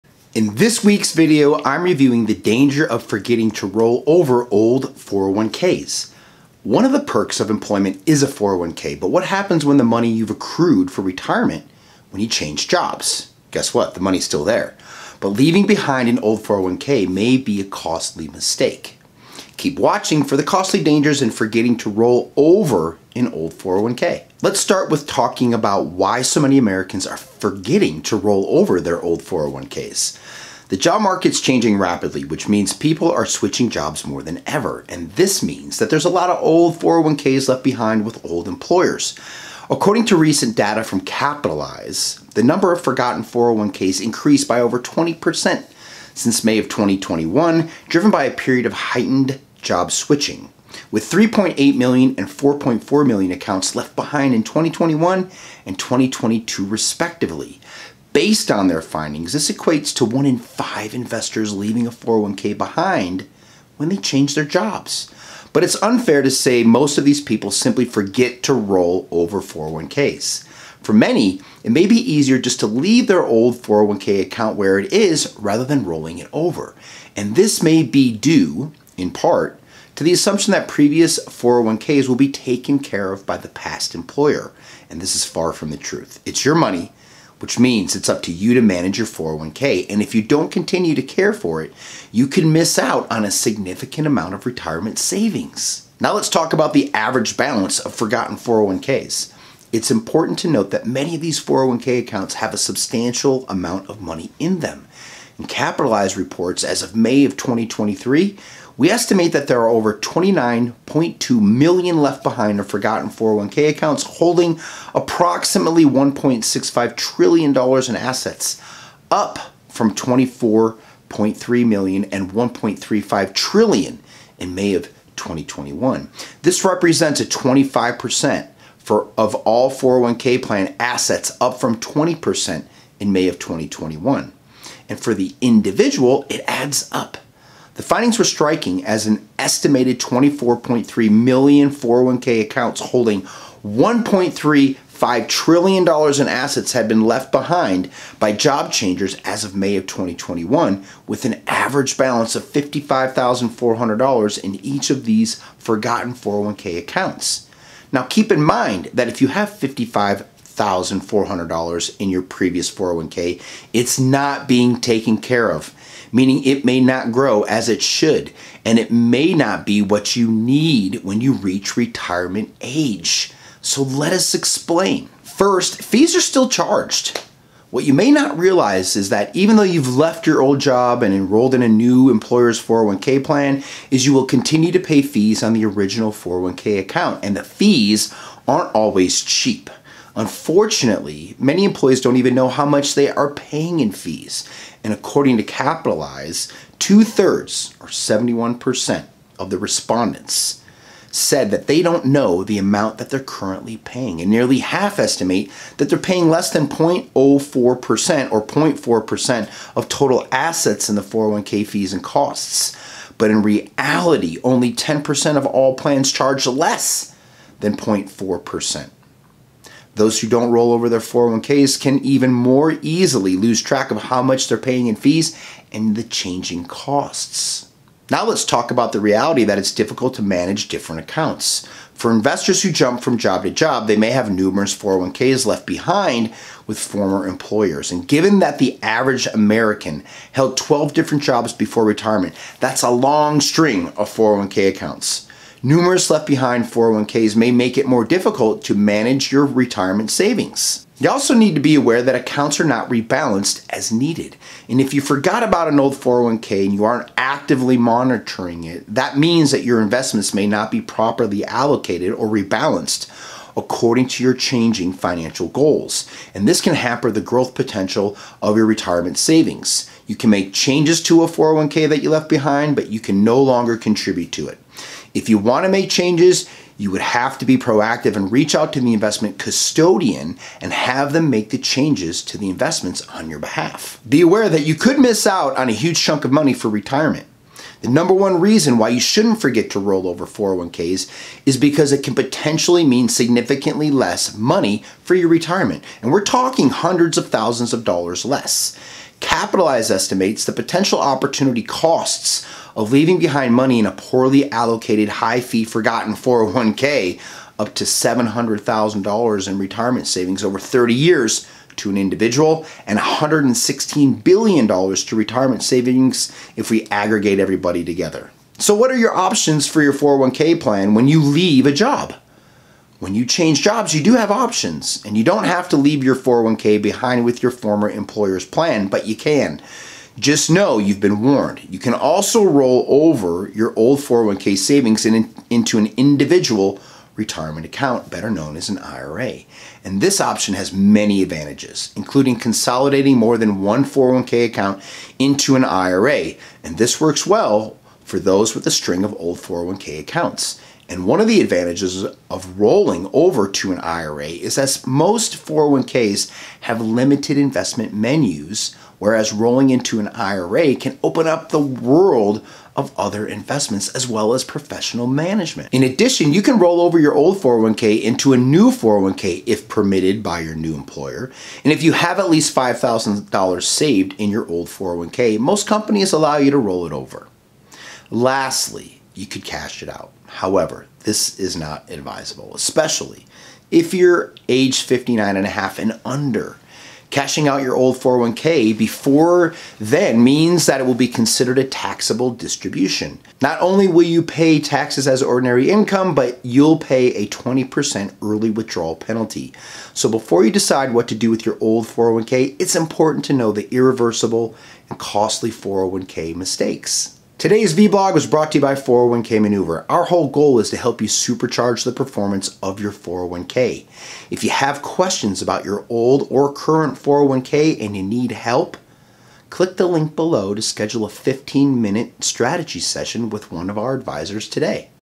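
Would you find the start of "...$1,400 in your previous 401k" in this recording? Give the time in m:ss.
2:40.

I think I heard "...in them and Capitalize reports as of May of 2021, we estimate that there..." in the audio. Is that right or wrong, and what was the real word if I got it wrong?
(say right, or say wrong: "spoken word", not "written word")
wrong: "2023", not "2021".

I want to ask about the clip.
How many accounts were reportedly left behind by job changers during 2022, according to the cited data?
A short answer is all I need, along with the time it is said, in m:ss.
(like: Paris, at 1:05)
4.4 million, at 0:52.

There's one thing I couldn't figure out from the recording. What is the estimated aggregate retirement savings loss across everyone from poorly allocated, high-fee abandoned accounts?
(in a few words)
$116 billion.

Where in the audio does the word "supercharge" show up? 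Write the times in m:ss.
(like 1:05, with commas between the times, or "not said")
6:51.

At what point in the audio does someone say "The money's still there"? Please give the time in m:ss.
0:13.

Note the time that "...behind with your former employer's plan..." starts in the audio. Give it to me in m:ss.
5:26.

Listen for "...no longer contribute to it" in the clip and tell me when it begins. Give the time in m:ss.
4:33.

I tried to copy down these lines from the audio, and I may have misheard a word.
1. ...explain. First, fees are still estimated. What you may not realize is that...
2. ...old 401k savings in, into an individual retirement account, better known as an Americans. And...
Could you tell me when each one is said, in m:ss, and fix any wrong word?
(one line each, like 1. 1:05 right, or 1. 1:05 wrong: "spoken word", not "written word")
1. 2:54 wrong: "charged", not "estimated"
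2. 5:33 wrong: "IRA", not "Americans".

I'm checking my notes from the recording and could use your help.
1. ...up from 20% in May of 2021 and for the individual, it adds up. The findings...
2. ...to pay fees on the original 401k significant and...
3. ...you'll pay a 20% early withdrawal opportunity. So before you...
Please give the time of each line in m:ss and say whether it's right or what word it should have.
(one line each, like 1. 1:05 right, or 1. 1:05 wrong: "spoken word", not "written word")
1. 2:11 right
2. 3:04 wrong: "account", not "significant"
3. 6:36 wrong: "penalty", not "opportunity".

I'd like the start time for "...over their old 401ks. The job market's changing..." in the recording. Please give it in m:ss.
0:28.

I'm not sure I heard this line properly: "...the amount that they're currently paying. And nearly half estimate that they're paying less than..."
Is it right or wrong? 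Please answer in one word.
right.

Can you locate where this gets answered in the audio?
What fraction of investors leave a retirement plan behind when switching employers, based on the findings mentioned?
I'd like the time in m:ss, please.
1:00.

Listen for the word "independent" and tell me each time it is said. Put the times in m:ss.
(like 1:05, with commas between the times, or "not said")
not said.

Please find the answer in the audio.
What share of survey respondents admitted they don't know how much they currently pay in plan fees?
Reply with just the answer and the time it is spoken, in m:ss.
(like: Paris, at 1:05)
71%, at 3:17.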